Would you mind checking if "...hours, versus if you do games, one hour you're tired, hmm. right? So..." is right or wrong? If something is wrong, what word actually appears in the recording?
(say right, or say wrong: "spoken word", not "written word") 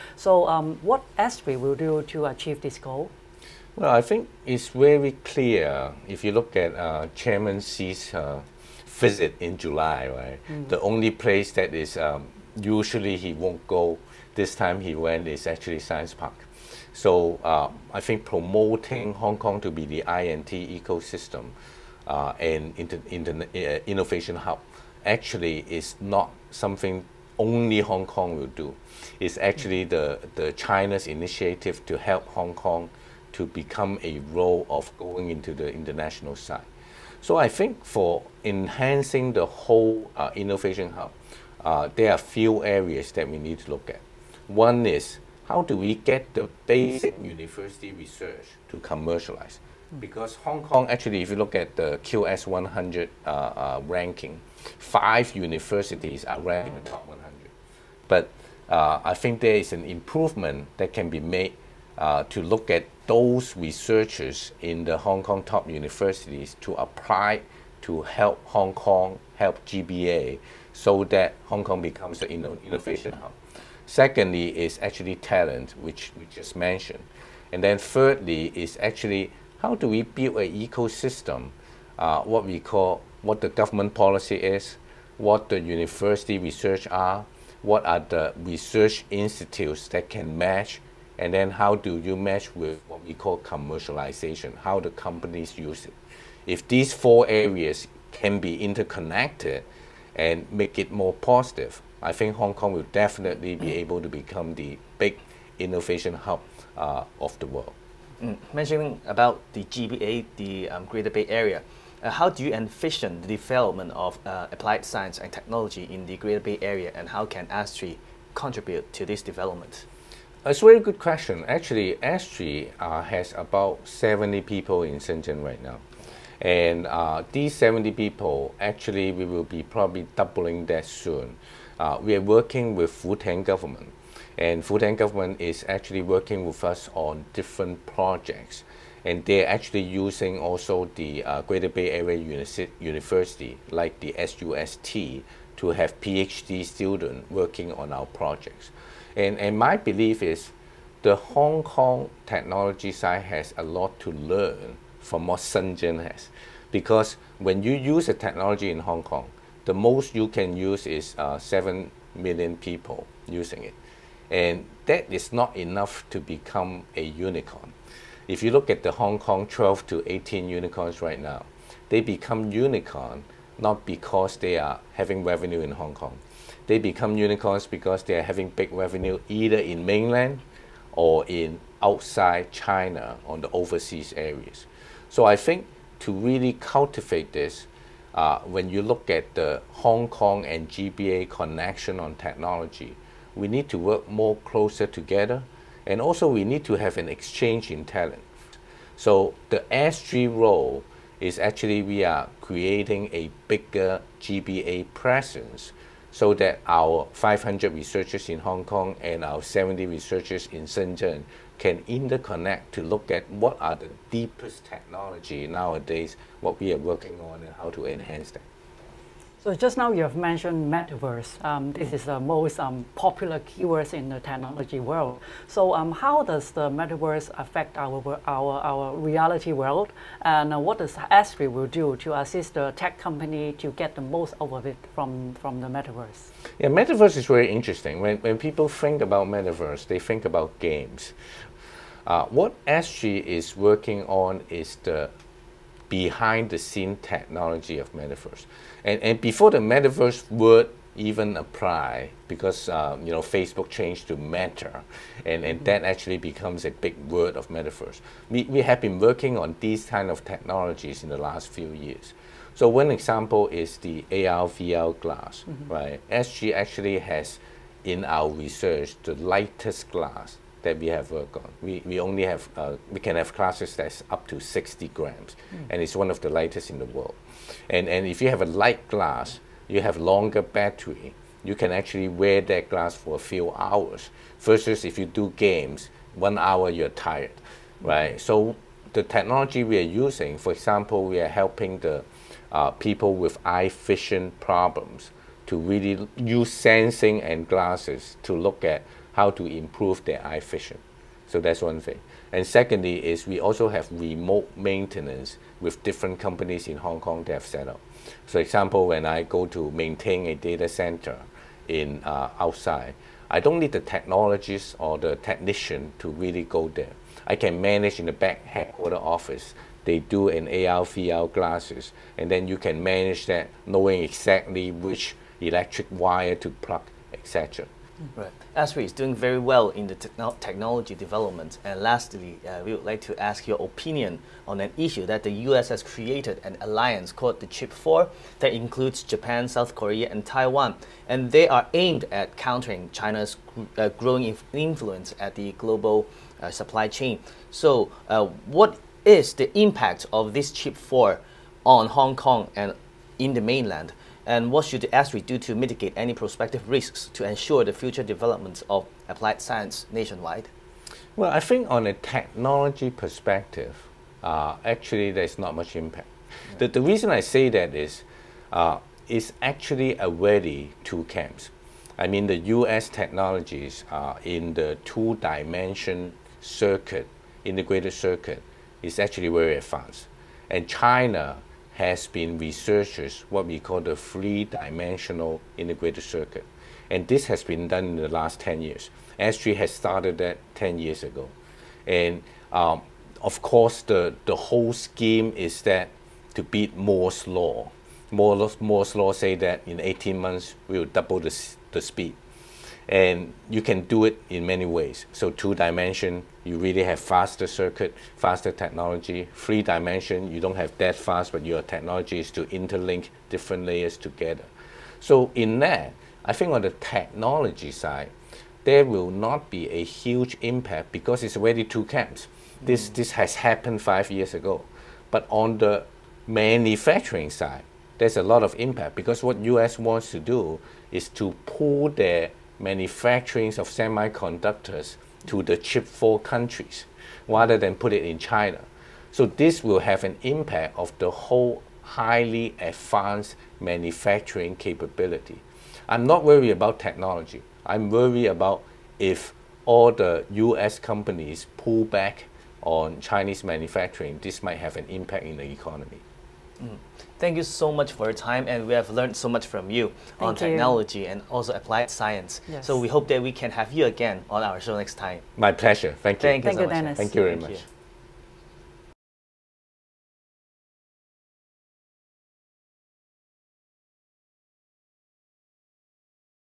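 right.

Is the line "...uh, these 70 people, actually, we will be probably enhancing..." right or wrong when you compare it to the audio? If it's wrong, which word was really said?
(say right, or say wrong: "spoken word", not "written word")
wrong: "doubling", not "enhancing".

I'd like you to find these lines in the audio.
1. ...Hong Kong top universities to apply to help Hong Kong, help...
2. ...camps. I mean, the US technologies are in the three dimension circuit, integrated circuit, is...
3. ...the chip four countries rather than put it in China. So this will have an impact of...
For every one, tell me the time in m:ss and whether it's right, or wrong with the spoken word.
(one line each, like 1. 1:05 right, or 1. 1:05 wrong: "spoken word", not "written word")
1. 1:04 right
2. 6:11 wrong: "two", not "three"
3. 7:15 right.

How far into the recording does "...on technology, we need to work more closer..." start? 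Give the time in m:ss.
3:11.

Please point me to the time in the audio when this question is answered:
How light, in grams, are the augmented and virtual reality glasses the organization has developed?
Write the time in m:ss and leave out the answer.
4:34.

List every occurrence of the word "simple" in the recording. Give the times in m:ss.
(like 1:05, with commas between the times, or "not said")
not said.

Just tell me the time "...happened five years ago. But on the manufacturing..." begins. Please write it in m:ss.
7:03.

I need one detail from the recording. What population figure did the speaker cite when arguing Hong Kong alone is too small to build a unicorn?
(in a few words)
7 million.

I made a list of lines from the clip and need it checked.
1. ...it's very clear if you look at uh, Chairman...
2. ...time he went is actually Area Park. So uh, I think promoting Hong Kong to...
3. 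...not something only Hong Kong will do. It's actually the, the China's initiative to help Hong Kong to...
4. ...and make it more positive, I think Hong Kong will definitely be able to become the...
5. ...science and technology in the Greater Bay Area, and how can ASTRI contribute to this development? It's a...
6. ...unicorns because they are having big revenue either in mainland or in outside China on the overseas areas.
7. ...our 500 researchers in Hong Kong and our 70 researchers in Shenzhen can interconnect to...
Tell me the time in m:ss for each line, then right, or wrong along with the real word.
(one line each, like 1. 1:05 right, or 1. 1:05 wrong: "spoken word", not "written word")
1. 0:04 right
2. 0:14 wrong: "Science", not "Area"
3. 0:26 right
4. 1:40 right
5. 1:54 right
6. 2:57 right
7. 3:26 right.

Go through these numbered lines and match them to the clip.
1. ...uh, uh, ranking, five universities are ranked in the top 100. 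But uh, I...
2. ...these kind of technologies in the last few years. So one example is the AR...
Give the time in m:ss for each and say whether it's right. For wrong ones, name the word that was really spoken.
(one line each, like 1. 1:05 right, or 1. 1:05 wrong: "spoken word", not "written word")
1. 0:53 right
2. 4:19 right.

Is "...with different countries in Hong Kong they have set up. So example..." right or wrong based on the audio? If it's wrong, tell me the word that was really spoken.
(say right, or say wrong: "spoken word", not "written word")
wrong: "companies", not "countries".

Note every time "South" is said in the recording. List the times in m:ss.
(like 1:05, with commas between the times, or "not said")
5:39.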